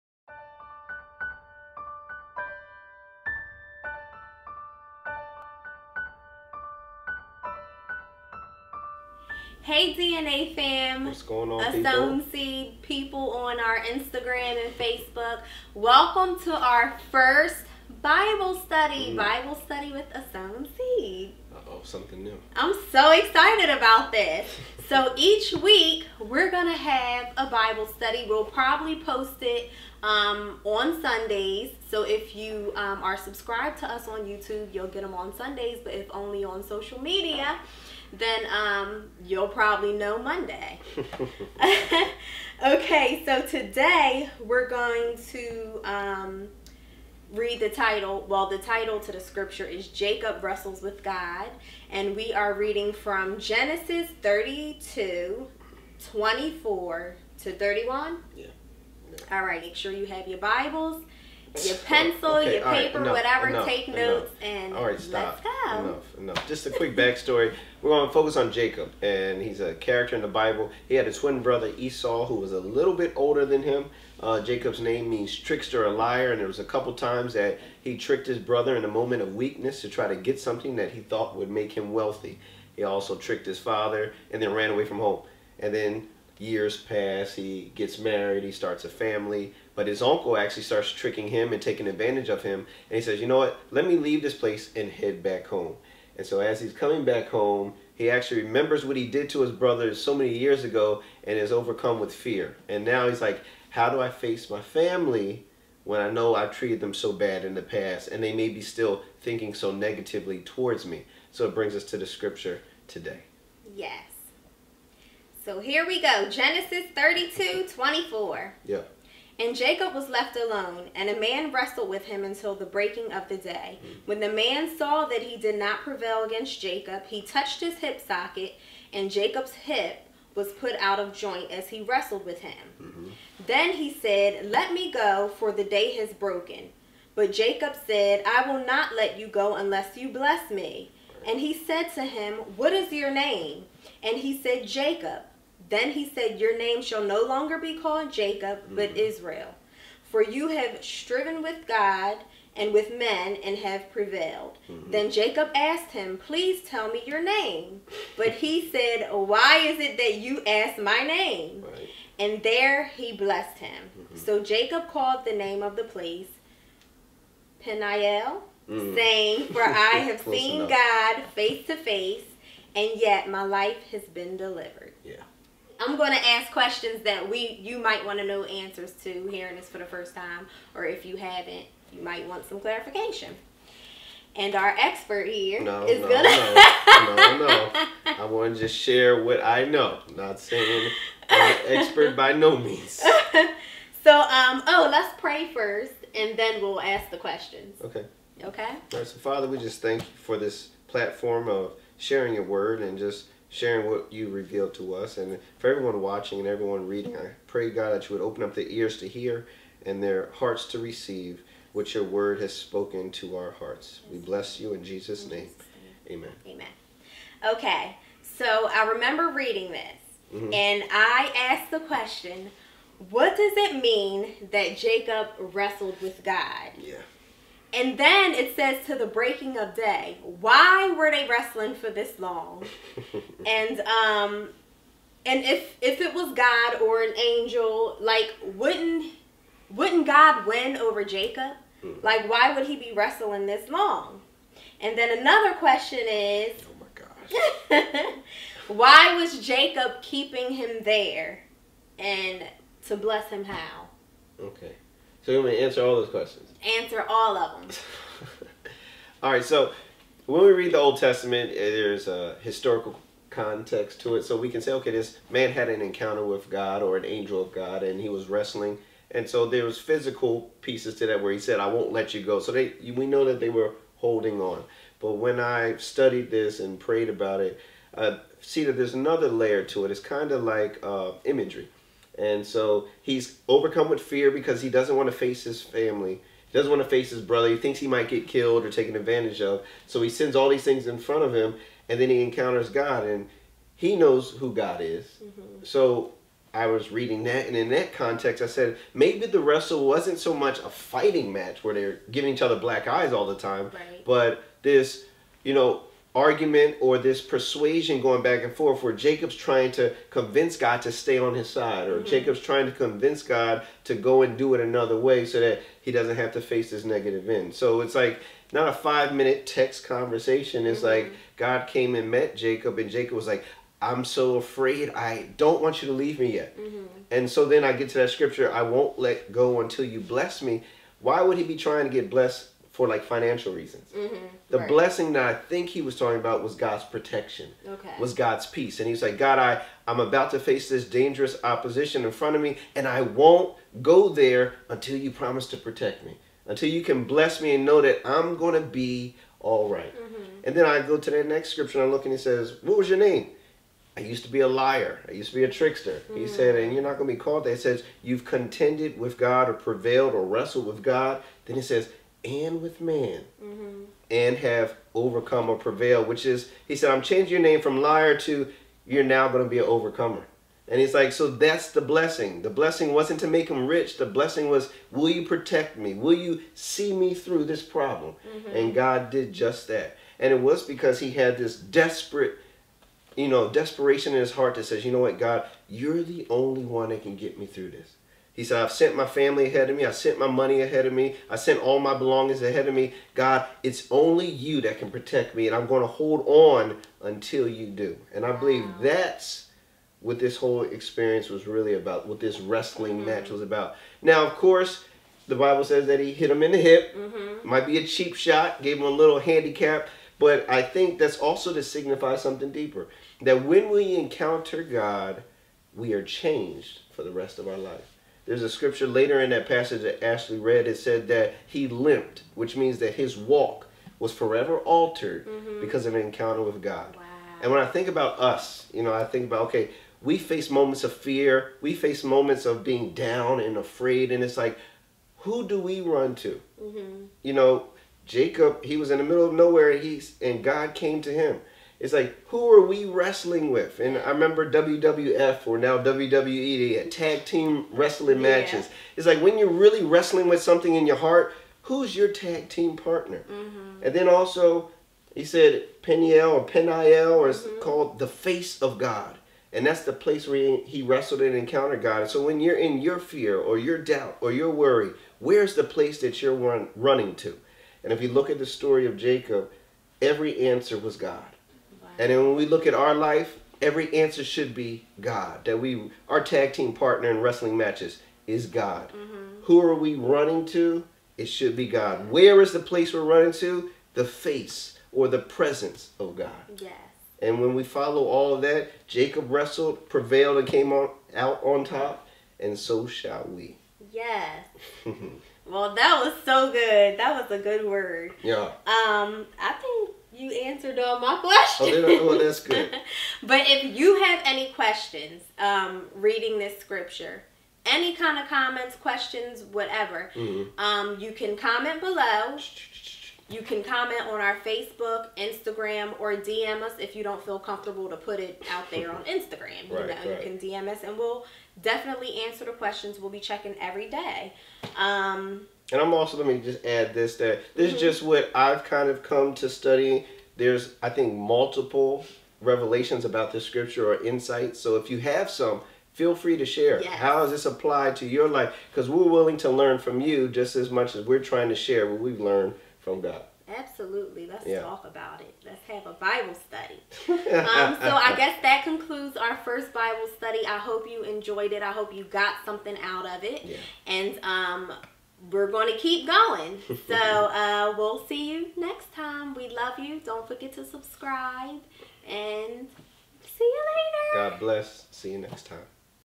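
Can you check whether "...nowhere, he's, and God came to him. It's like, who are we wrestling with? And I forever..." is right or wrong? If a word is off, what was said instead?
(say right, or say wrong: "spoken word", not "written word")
wrong: "remember", not "forever".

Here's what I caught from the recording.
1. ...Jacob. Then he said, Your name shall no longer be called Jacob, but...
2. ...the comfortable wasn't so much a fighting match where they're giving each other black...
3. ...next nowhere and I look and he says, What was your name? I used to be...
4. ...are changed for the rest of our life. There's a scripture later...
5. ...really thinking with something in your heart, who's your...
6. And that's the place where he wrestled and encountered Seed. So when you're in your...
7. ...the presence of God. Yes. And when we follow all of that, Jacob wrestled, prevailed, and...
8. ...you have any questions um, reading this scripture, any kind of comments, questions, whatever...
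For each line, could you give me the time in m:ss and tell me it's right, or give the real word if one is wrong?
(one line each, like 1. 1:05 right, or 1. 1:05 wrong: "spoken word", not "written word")
1. 2:24 right
2. 4:59 wrong: "wrestle", not "comfortable"
3. 5:51 wrong: "scripture", not "nowhere"
4. 6:55 right
5. 7:29 wrong: "wrestling", not "thinking"
6. 7:39 wrong: "God", not "Seed"
7. 8:05 right
8. 8:23 right.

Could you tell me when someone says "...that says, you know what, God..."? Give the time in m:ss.
6:24.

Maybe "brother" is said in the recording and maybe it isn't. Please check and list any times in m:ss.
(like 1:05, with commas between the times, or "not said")
1:11, 1:18, 1:39, 4:47.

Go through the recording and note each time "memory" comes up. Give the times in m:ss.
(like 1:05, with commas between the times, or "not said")
not said.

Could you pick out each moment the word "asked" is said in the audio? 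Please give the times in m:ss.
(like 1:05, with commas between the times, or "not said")
2:35, 3:41.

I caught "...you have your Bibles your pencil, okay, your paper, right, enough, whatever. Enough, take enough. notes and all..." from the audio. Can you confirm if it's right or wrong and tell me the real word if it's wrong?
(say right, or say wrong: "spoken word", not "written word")
right.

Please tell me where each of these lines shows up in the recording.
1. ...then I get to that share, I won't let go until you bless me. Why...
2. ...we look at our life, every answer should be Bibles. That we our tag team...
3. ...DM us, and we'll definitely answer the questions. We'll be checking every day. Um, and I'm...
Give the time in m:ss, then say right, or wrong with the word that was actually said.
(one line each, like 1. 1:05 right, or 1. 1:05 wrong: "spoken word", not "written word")
1. 5:27 wrong: "scripture", not "share"
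2. 7:52 wrong: "God", not "Bibles"
3. 8:40 right.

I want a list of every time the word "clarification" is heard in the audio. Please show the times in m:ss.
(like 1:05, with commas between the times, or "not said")
3:02.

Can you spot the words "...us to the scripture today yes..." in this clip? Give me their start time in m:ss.
1:51.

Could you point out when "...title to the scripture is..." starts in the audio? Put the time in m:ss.
0:48.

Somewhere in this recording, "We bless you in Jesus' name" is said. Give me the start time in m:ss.
3:34.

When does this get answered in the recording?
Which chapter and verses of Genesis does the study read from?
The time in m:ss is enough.
0:53.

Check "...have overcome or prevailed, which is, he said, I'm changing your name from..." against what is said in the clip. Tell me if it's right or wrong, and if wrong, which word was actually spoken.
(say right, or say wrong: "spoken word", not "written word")
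right.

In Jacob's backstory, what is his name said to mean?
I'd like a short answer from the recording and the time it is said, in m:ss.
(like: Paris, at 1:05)
trickster or liar, at 1:15.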